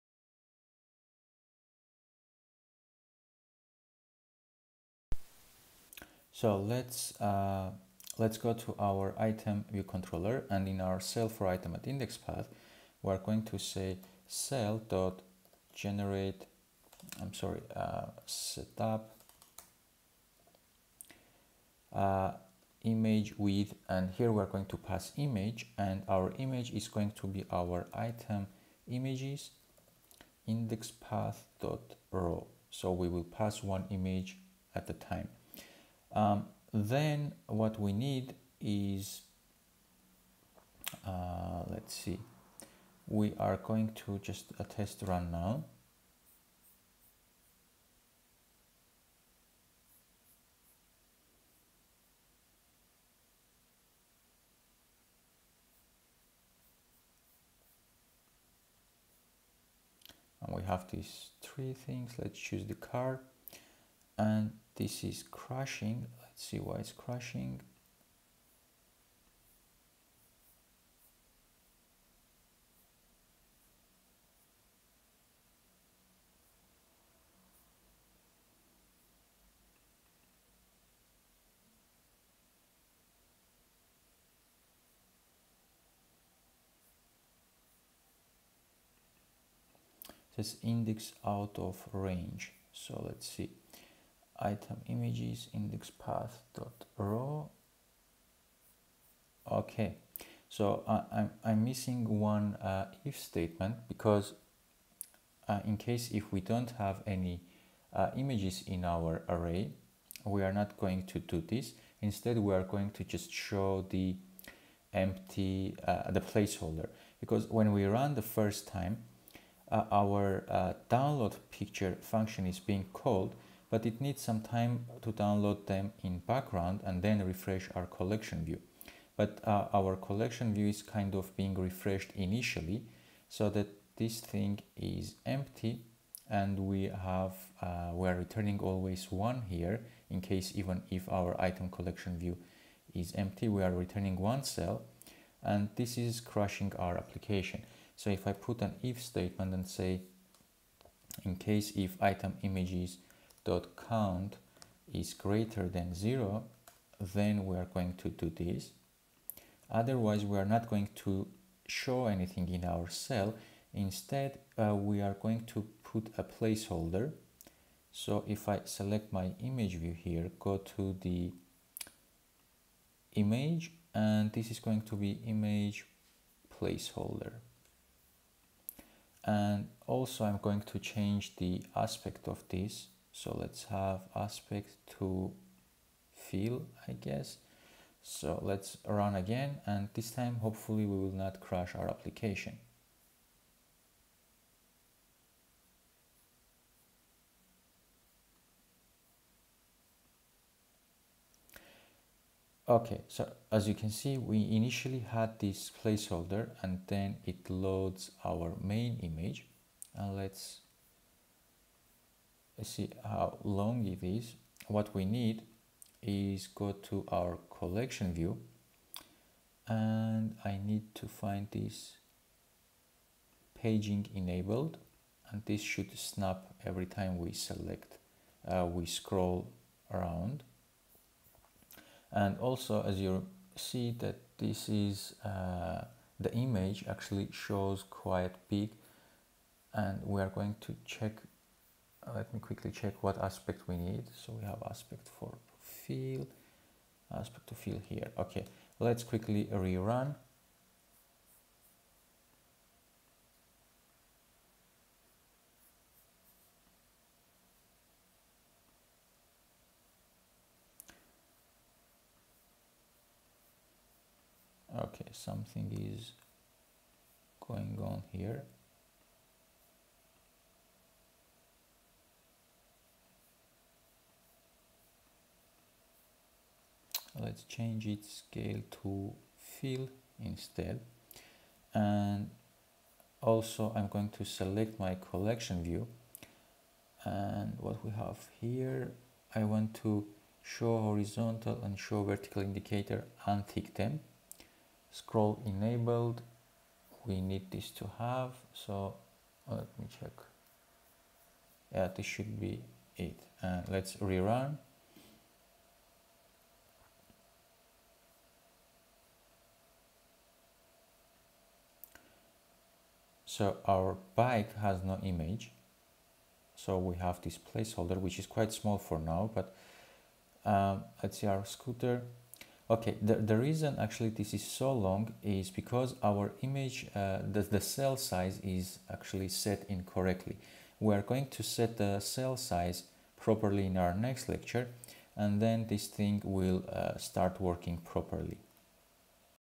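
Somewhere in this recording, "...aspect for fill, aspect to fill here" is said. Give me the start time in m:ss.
4:04.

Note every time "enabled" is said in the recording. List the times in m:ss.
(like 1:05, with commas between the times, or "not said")
3:44, 4:55.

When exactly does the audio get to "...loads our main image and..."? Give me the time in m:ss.
3:27.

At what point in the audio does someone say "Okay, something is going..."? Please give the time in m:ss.
4:24.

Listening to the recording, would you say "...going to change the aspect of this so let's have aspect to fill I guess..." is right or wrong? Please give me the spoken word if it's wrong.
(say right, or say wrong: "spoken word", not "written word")
right.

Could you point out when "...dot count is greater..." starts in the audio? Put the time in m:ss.
2:33.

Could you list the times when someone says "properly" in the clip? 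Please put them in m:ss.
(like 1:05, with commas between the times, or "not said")
5:33, 5:37.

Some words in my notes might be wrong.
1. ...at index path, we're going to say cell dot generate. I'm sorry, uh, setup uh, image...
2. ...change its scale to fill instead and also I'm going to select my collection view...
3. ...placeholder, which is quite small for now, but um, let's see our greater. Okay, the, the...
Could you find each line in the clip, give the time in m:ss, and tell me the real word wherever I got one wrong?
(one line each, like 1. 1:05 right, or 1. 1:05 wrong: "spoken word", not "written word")
1. 0:11 right
2. 4:37 right
3. 5:17 wrong: "scooter", not "greater".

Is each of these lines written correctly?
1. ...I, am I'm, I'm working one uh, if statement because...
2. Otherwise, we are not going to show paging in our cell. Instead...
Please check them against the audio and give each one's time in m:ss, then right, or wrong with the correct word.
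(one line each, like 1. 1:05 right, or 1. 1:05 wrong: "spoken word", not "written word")
1. 1:40 wrong: "missing", not "working"
2. 2:39 wrong: "anything", not "paging".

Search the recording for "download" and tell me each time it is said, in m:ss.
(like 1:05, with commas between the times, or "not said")
2:00, 2:05.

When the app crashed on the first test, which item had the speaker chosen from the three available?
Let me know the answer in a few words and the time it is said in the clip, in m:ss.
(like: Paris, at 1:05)
The car, at 1:02.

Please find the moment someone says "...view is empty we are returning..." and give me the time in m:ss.
2:22.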